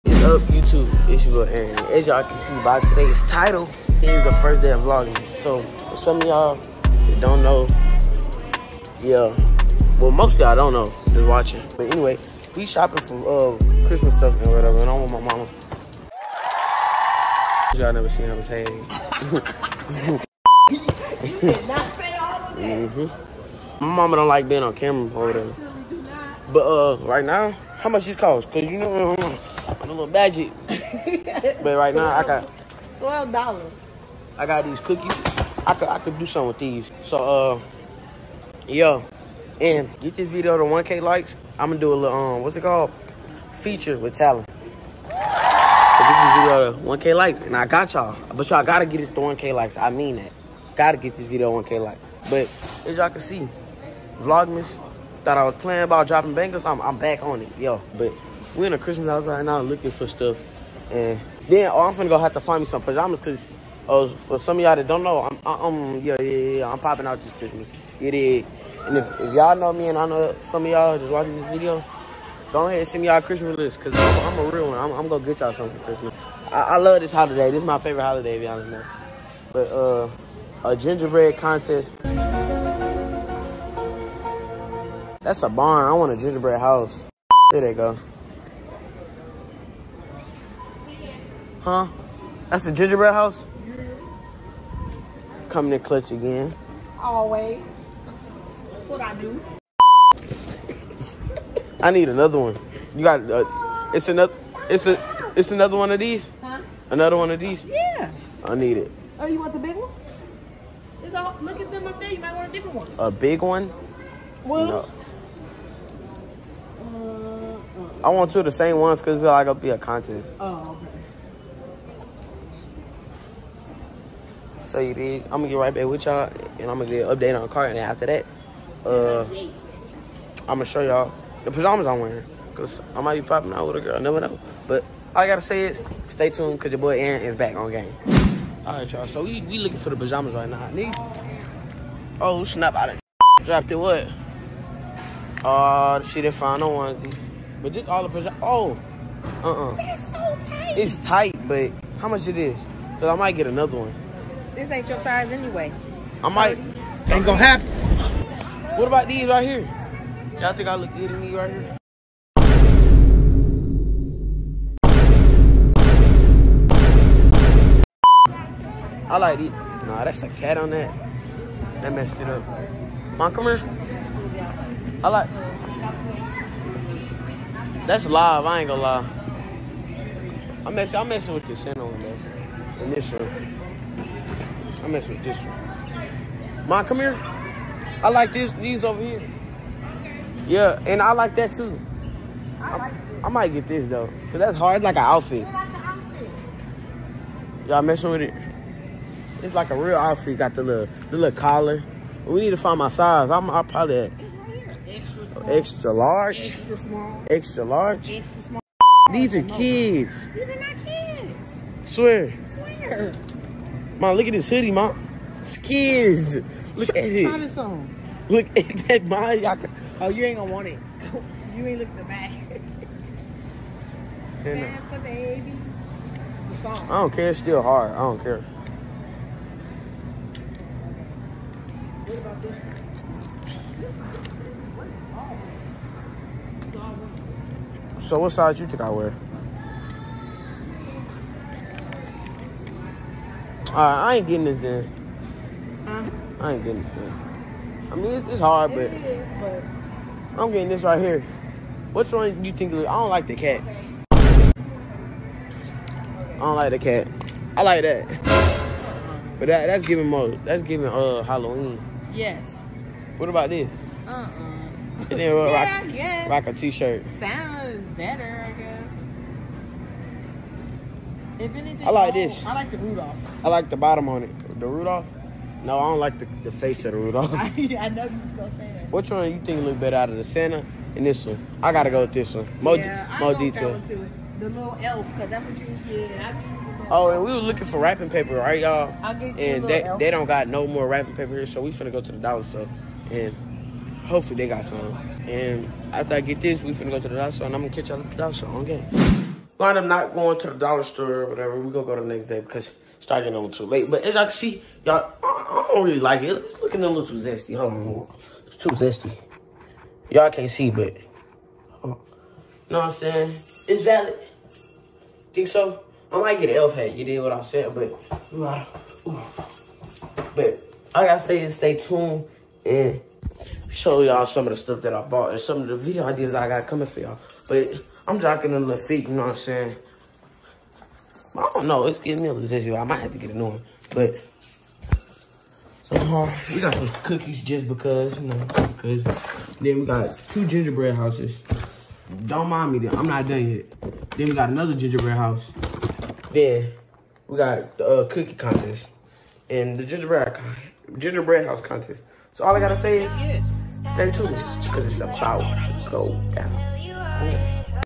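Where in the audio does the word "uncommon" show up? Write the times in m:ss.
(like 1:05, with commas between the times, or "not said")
not said.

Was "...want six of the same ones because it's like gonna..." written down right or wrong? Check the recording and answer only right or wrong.
wrong.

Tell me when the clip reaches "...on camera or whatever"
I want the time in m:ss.
0:24.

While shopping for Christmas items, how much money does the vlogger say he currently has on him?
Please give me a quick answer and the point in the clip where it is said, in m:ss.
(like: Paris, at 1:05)
$12, at 0:32.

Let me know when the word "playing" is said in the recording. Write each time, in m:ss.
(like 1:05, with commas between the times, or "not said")
0:55.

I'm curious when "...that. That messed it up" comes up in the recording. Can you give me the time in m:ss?
2:50.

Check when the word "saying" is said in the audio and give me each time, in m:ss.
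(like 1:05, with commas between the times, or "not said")
5:12, 5:17, 5:29.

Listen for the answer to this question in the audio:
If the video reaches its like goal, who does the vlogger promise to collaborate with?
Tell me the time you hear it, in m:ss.
0:44.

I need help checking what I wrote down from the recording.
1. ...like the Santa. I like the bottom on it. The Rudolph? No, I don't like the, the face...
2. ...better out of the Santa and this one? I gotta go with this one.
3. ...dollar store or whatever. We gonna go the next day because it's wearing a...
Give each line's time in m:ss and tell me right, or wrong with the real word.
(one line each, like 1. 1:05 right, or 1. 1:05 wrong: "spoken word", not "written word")
1. 4:32 wrong: "Rudolph", not "Santa"
2. 4:39 right
3. 5:00 wrong: "starting", not "wearing".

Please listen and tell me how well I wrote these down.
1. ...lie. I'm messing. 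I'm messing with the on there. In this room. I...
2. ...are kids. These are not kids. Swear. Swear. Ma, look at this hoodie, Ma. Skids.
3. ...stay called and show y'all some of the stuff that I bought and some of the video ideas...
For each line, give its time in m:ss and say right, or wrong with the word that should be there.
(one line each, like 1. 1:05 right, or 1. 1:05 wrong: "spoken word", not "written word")
1. 2:58 right
2. 3:29 right
3. 5:21 wrong: "tuned", not "called".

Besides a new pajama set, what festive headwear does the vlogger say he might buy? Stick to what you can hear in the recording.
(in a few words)
elf hat.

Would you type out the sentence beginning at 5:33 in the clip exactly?
But somehow we got some cookies just because, you know, because.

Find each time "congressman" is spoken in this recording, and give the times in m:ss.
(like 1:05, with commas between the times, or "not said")
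not said.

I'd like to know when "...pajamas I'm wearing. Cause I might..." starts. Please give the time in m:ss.
2:11.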